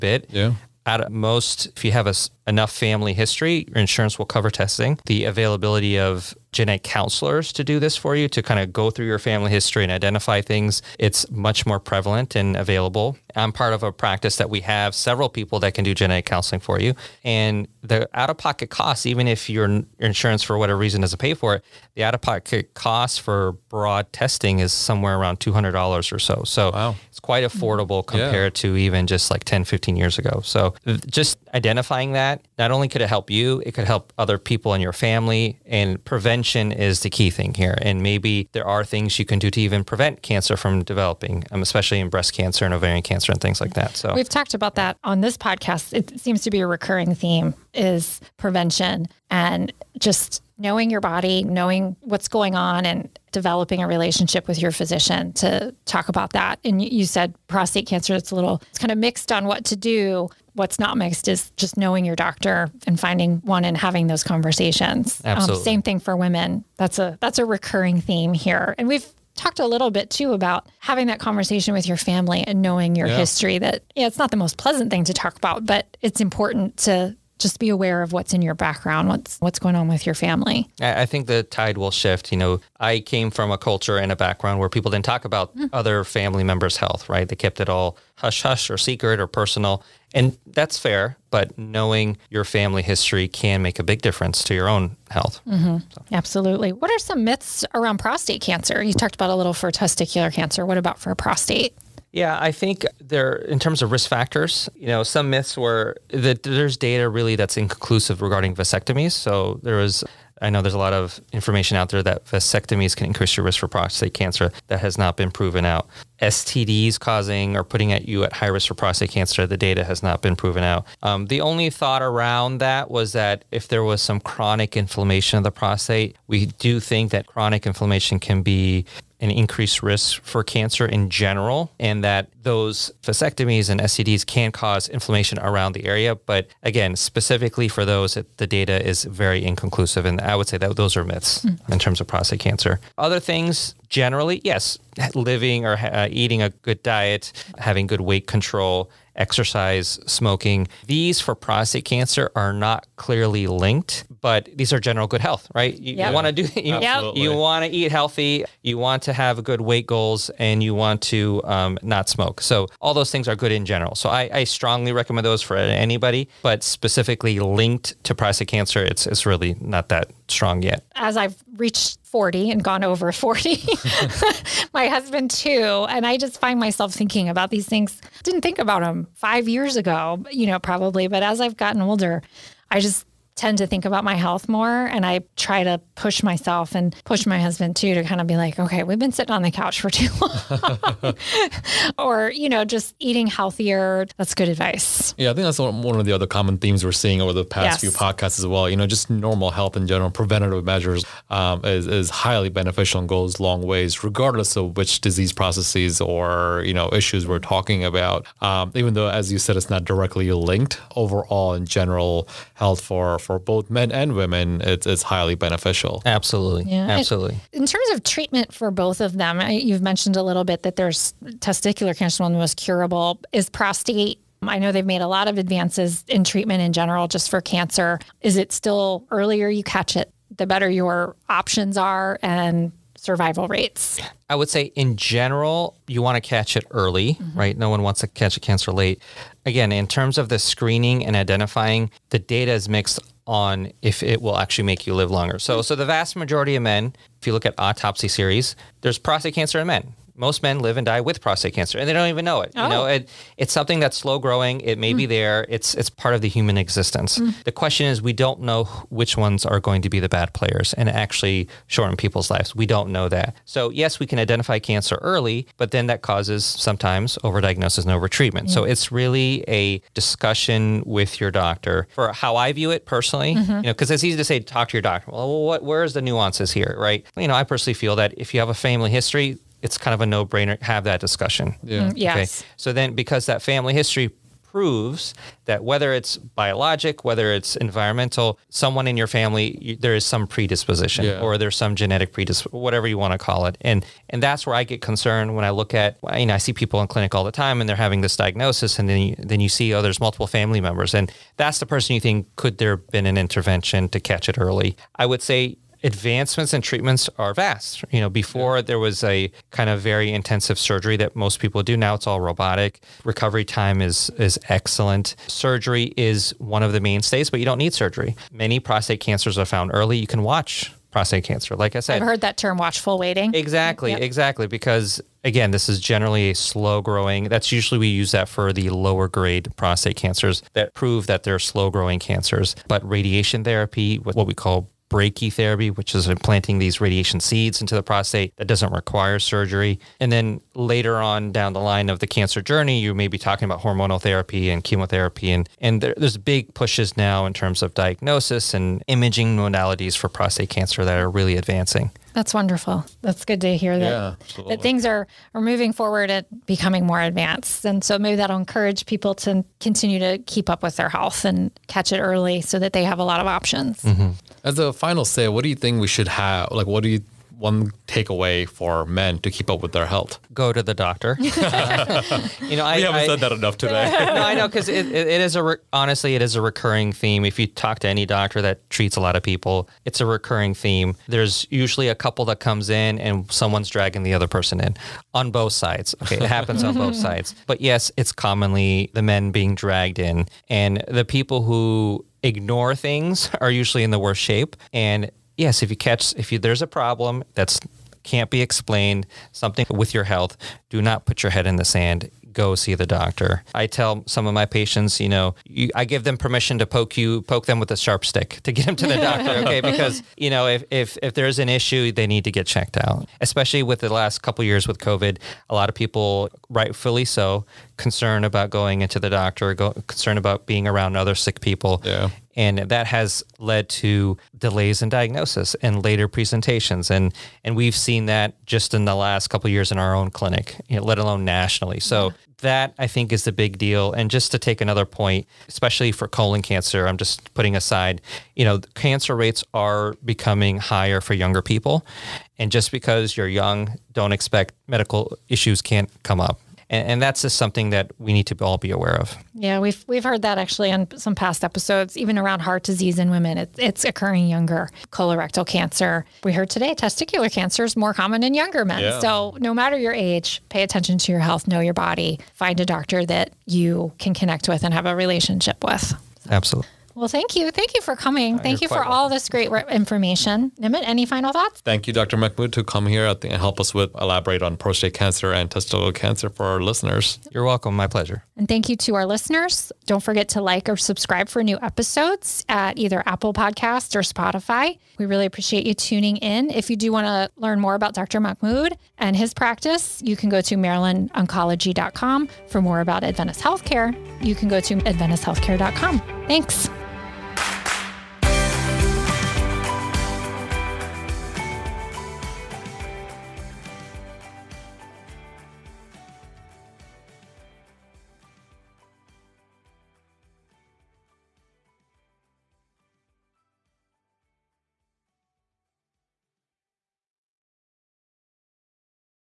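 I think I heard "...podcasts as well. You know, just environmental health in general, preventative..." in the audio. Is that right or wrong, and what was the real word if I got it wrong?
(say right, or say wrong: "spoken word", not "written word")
wrong: "normal", not "environmental".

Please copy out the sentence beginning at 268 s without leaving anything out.
So it's really a discussion with your doctor for how I view it personally.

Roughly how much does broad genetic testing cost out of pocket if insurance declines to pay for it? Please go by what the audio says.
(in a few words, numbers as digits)
$200.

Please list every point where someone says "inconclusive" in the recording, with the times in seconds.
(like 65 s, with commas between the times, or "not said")
107 s, 139 s.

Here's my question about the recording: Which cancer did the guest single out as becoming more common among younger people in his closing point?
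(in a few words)
colon cancer.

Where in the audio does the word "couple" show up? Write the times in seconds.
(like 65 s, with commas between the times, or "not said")
381 s, 414 s, 429 s.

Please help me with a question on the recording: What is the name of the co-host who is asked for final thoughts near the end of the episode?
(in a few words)
Nimeet.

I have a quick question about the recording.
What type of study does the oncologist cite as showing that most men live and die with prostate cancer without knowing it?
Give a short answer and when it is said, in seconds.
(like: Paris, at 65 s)
autopsy series, at 247 s.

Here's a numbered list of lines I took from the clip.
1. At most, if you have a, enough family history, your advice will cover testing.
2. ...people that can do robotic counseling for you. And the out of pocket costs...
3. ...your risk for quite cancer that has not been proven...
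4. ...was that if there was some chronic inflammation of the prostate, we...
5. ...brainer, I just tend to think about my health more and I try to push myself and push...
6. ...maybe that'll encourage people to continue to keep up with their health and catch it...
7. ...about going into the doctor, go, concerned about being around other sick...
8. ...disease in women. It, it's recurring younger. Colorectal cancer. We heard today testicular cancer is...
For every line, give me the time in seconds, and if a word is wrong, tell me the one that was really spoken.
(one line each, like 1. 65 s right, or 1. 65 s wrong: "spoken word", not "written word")
1. 0 s wrong: "insurance", not "advice"
2. 15 s wrong: "genetic", not "robotic"
3. 113 s wrong: "prostate", not "quite"
4. 122 s right
5. 181 s wrong: "older", not "brainer"
6. 357 s right
7. 418 s right
8. 452 s wrong: "occurring", not "recurring".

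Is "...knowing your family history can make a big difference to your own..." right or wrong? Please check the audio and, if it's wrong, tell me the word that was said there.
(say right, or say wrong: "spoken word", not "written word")
right.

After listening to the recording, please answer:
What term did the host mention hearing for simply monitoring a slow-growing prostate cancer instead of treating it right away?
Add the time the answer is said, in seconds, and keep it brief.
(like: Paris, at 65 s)
watchful waiting, at 322 s.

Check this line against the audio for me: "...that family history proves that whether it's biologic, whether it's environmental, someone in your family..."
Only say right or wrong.
right.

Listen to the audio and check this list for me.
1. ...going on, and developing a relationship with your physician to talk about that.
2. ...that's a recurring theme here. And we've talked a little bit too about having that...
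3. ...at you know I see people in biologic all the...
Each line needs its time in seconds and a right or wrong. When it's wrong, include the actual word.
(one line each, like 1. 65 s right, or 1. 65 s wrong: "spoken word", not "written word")
1. 52 s right
2. 67 s right
3. 295 s wrong: "clinic", not "biologic".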